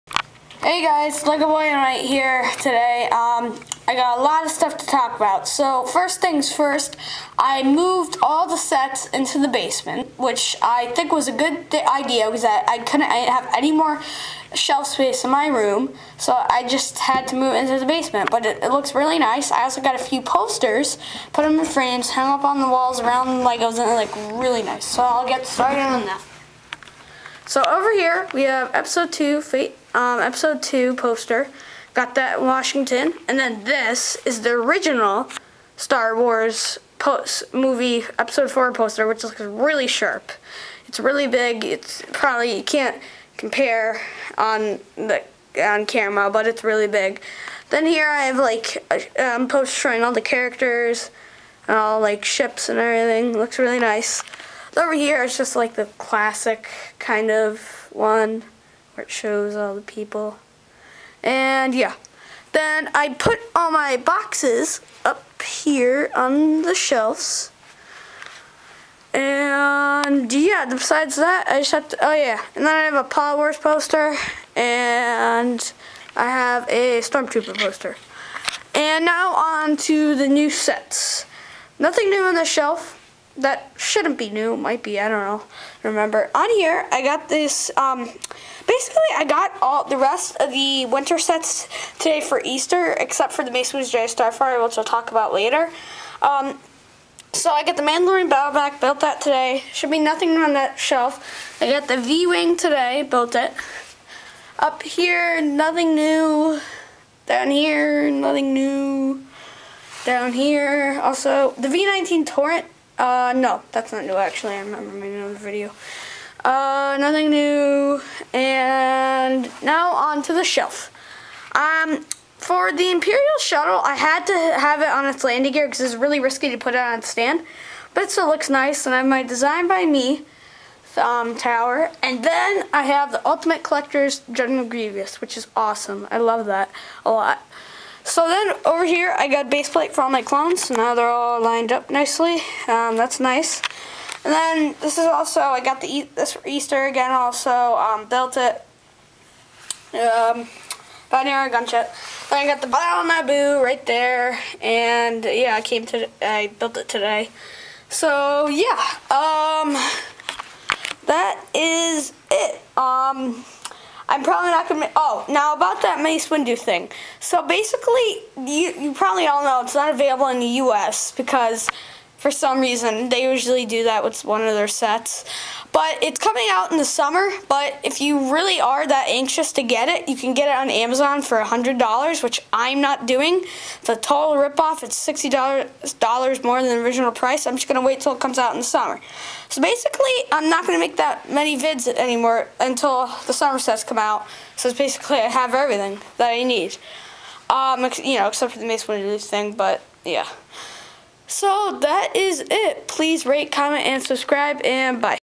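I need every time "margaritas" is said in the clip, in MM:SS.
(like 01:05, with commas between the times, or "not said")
not said.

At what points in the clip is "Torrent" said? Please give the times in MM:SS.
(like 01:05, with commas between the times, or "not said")
01:52.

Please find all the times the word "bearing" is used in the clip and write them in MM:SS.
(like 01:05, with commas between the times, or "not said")
not said.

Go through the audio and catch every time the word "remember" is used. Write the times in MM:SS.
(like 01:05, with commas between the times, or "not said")
01:25, 01:54.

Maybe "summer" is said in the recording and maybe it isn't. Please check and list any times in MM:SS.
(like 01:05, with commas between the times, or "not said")
02:56, 03:08, 03:13.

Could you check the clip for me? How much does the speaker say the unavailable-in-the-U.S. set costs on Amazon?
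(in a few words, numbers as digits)
$100.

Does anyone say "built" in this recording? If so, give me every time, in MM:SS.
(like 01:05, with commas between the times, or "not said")
01:38, 01:43, 02:28, 02:36.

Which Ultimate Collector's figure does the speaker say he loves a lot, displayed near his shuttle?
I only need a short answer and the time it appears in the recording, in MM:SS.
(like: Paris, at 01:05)
General Grievous, at 02:14.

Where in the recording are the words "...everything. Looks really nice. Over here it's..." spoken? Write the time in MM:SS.
00:52.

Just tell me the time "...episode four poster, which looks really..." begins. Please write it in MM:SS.
00:38.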